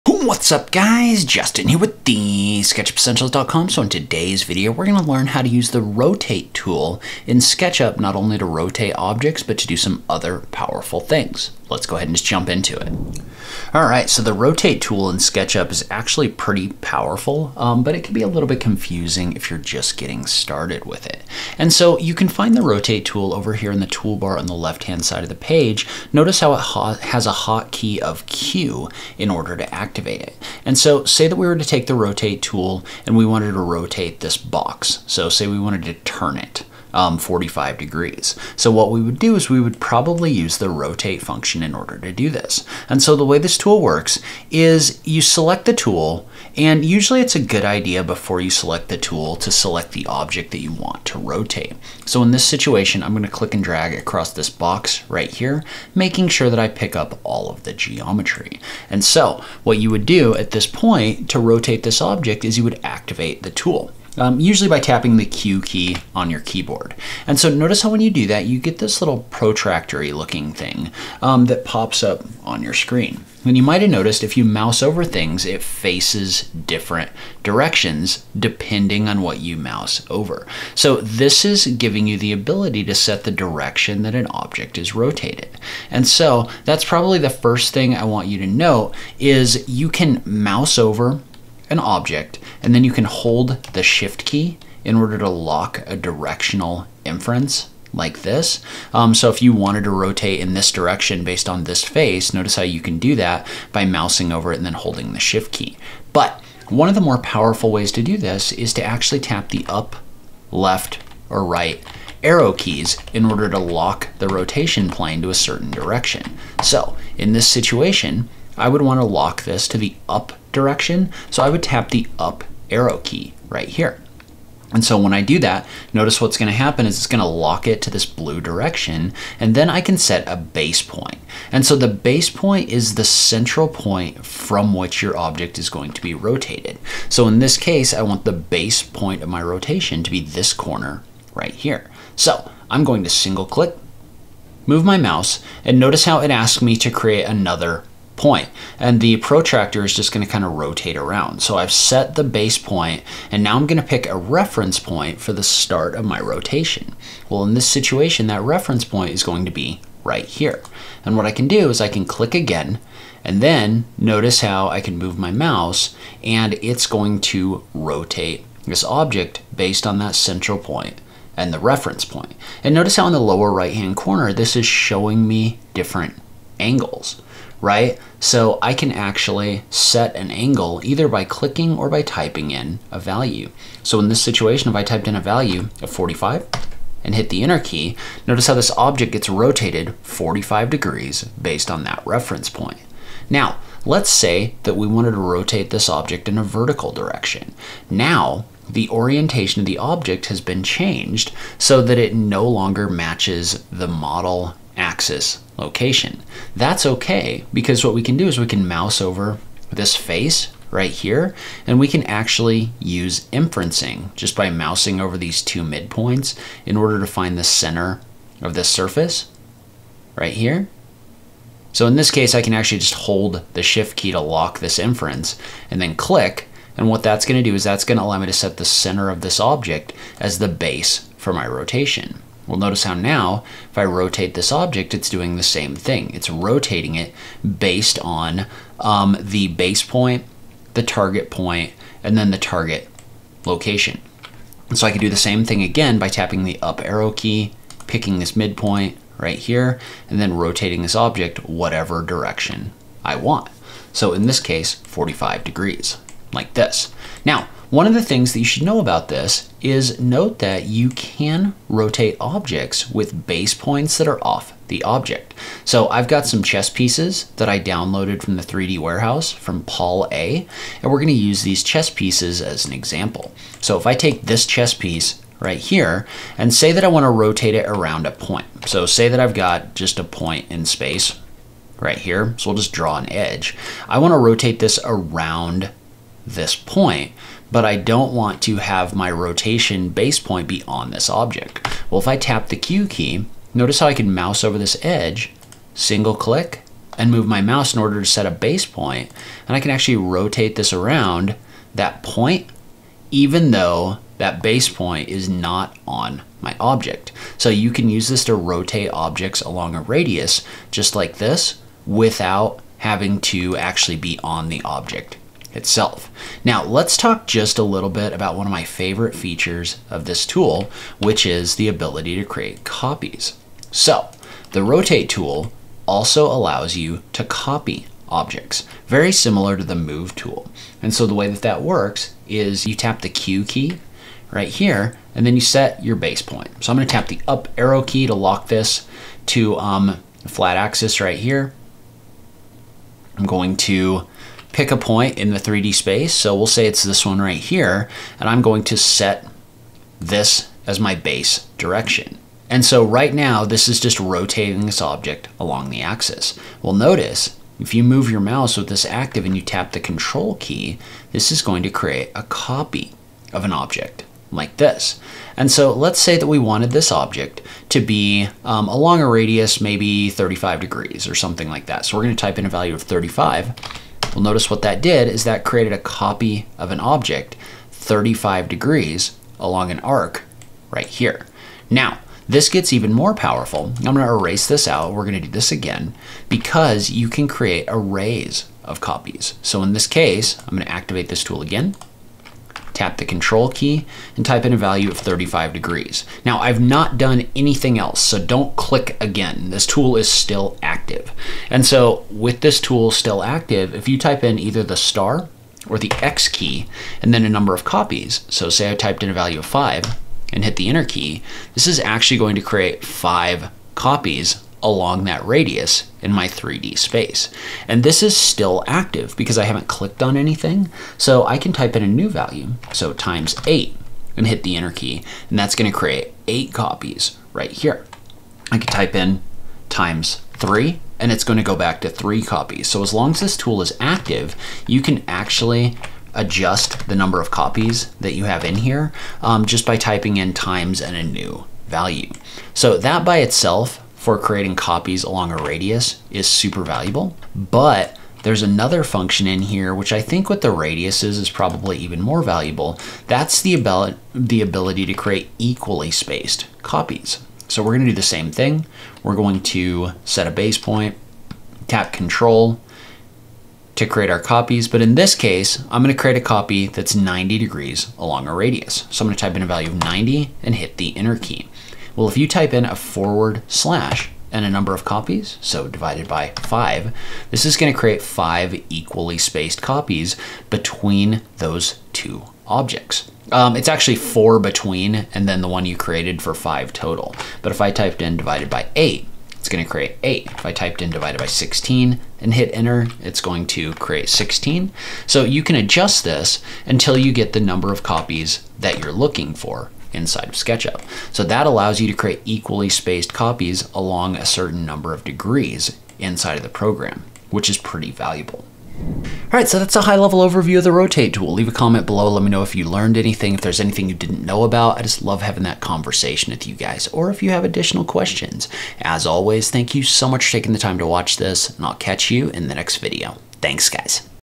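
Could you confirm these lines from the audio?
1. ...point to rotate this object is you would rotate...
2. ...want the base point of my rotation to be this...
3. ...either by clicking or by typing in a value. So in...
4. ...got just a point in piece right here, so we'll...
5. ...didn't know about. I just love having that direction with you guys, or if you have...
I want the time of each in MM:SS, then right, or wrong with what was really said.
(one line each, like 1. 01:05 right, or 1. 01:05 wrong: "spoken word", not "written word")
1. 01:00 wrong: "activate", not "rotate"
2. 02:18 right
3. 03:00 right
4. 04:39 wrong: "space", not "piece"
5. 08:33 wrong: "conversation", not "direction".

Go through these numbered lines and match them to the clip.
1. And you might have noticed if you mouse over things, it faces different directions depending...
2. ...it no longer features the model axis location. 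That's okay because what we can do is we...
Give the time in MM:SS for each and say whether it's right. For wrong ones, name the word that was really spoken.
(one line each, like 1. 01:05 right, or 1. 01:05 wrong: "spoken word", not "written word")
1. 01:13 right
2. 03:21 wrong: "matches", not "features".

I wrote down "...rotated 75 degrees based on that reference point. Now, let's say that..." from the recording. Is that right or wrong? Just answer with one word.
wrong.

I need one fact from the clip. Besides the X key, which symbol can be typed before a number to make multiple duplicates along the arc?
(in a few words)
Star.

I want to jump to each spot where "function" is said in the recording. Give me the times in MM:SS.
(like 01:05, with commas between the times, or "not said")
00:41, 07:28.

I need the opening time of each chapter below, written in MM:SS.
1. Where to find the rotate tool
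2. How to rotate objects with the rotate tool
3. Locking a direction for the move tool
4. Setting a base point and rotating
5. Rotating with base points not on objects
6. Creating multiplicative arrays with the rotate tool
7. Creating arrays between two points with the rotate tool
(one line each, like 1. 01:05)
1. 00:14
2. 00:44
3. 01:34
4. 02:17
5. 04:23
6. 05:20
7. 07:40.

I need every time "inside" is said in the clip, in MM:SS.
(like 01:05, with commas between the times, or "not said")
08:19, 08:25.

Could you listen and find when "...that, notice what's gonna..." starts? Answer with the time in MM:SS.
02:05.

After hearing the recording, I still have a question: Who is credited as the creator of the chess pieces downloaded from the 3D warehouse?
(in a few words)
Paul A.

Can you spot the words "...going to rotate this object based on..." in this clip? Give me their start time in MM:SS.
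02:46.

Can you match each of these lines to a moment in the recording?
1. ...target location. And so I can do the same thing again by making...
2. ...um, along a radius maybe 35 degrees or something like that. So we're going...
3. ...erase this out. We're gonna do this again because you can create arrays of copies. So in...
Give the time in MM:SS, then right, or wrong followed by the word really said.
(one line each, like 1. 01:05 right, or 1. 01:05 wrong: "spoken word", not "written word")
1. 04:02 wrong: "tapping", not "making"
2. 06:08 right
3. 06:24 right.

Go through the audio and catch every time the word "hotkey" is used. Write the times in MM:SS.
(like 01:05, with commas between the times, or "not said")
00:27.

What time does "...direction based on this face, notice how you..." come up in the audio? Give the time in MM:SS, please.
01:40.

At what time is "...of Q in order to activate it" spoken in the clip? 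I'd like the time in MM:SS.
00:27.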